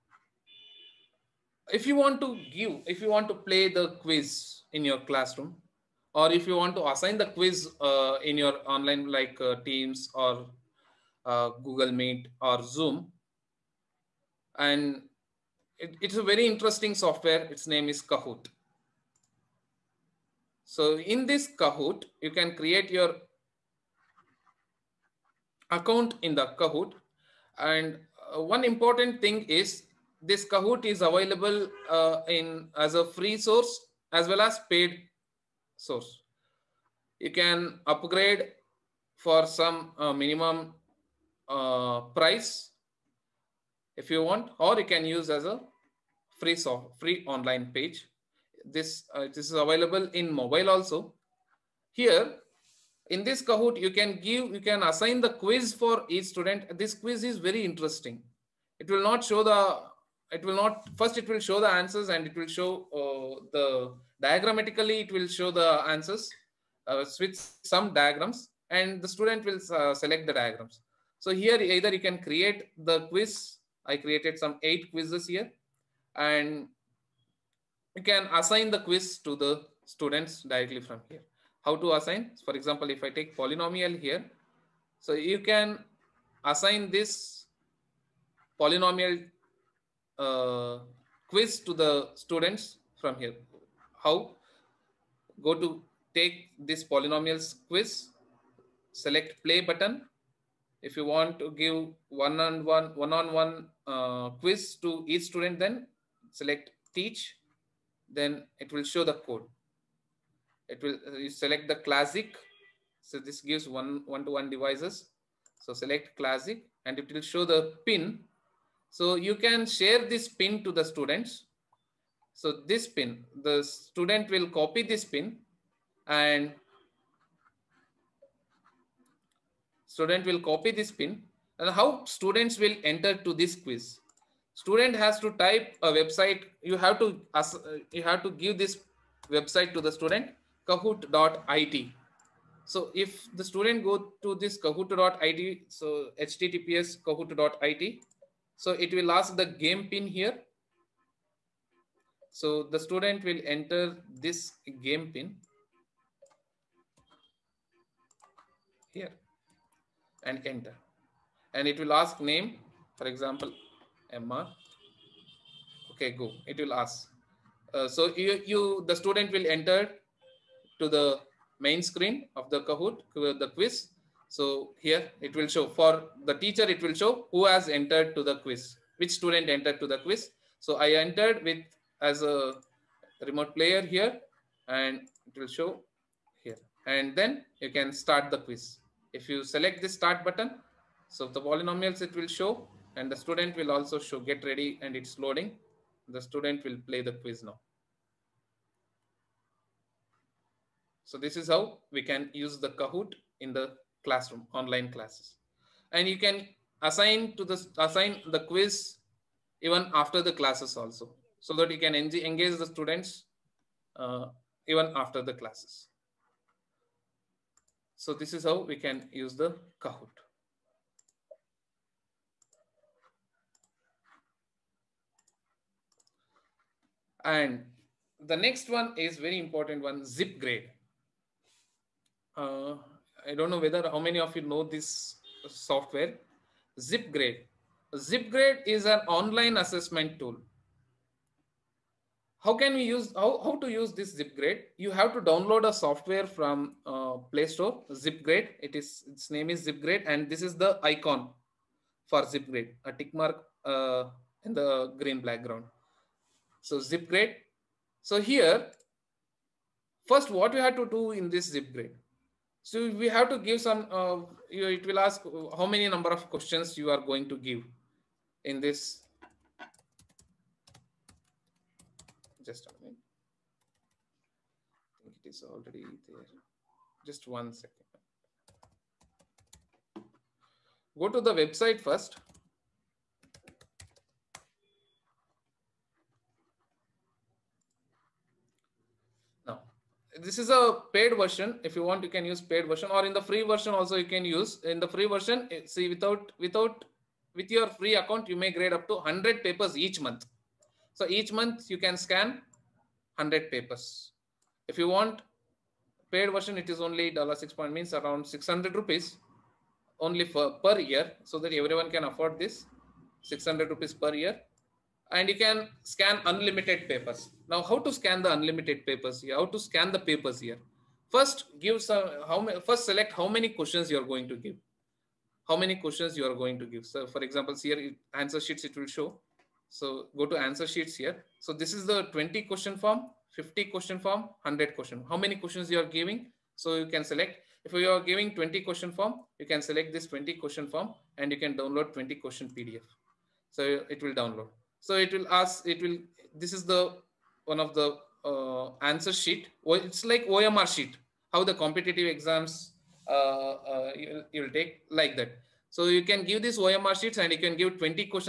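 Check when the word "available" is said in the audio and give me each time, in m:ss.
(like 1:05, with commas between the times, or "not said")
0:31, 0:49.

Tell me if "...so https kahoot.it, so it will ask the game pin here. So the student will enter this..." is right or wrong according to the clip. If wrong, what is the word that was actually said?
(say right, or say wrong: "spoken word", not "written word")
right.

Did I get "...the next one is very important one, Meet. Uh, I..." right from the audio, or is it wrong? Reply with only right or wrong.
wrong.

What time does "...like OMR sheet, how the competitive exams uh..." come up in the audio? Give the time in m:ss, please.
5:50.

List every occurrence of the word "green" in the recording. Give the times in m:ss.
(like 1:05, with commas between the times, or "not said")
4:14.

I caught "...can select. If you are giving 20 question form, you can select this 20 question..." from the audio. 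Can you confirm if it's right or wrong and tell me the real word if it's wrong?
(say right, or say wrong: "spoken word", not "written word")
right.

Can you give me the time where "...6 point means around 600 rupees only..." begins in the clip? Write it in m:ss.
5:07.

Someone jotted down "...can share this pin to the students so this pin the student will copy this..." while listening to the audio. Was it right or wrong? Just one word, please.
right.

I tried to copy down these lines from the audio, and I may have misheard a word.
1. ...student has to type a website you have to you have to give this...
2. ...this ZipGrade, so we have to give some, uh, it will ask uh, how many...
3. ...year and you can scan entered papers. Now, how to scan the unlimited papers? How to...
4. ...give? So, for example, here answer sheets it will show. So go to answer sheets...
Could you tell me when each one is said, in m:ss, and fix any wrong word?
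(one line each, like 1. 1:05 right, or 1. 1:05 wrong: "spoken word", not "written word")
1. 2:14 right
2. 4:21 right
3. 5:14 wrong: "unlimited", not "entered"
4. 5:26 right.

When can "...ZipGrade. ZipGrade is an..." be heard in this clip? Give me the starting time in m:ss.
3:56.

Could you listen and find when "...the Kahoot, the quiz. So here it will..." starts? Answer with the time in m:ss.
2:52.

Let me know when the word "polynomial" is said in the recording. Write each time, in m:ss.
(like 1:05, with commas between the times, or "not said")
1:23, 1:28, 1:36, 3:11.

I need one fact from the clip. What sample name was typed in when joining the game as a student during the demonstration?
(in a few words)
Emma.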